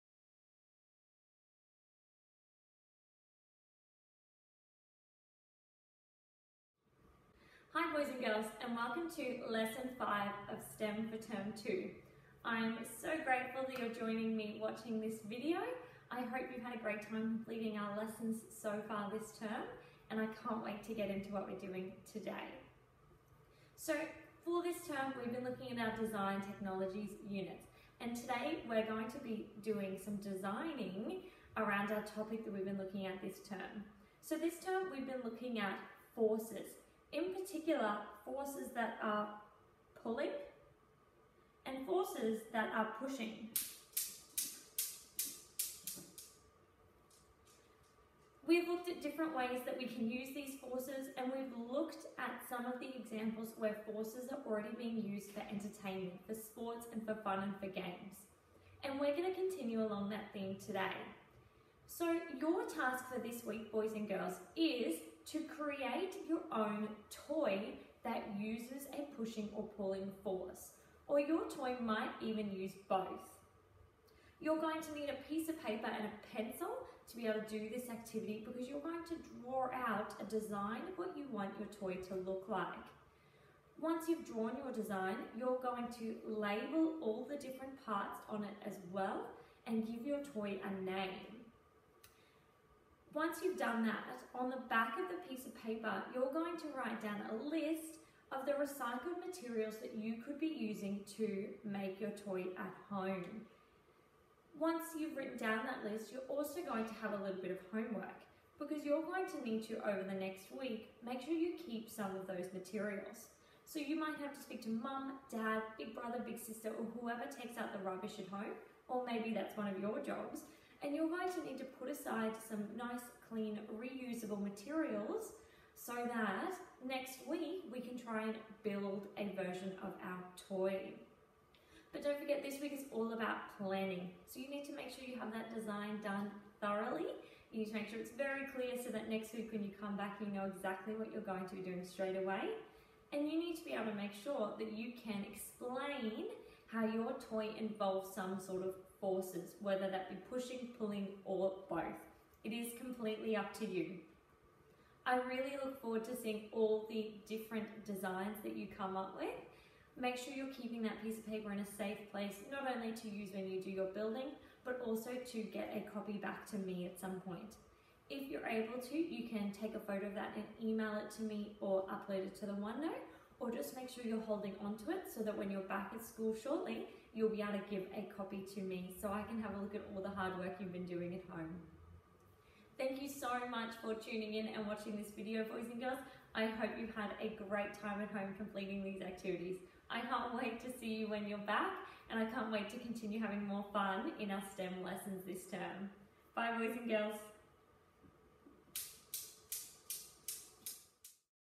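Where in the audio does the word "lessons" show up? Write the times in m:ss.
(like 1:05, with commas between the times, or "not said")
0:09, 0:17, 3:14.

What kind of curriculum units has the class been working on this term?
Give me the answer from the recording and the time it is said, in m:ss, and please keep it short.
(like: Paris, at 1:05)
design technologies, at 0:26.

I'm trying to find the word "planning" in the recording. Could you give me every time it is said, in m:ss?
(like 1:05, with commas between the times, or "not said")
2:13.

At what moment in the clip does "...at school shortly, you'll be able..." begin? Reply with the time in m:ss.
2:55.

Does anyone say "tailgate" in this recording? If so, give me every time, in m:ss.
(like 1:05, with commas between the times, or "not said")
not said.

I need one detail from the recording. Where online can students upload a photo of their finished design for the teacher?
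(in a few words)
OneNote.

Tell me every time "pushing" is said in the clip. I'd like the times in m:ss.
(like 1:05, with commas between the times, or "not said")
0:43, 1:09, 2:30.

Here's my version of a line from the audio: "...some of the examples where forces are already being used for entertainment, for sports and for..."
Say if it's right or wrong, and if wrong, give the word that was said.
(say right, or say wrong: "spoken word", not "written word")
right.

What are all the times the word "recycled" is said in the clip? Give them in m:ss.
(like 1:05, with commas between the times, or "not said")
1:38.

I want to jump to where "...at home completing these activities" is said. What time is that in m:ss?
3:08.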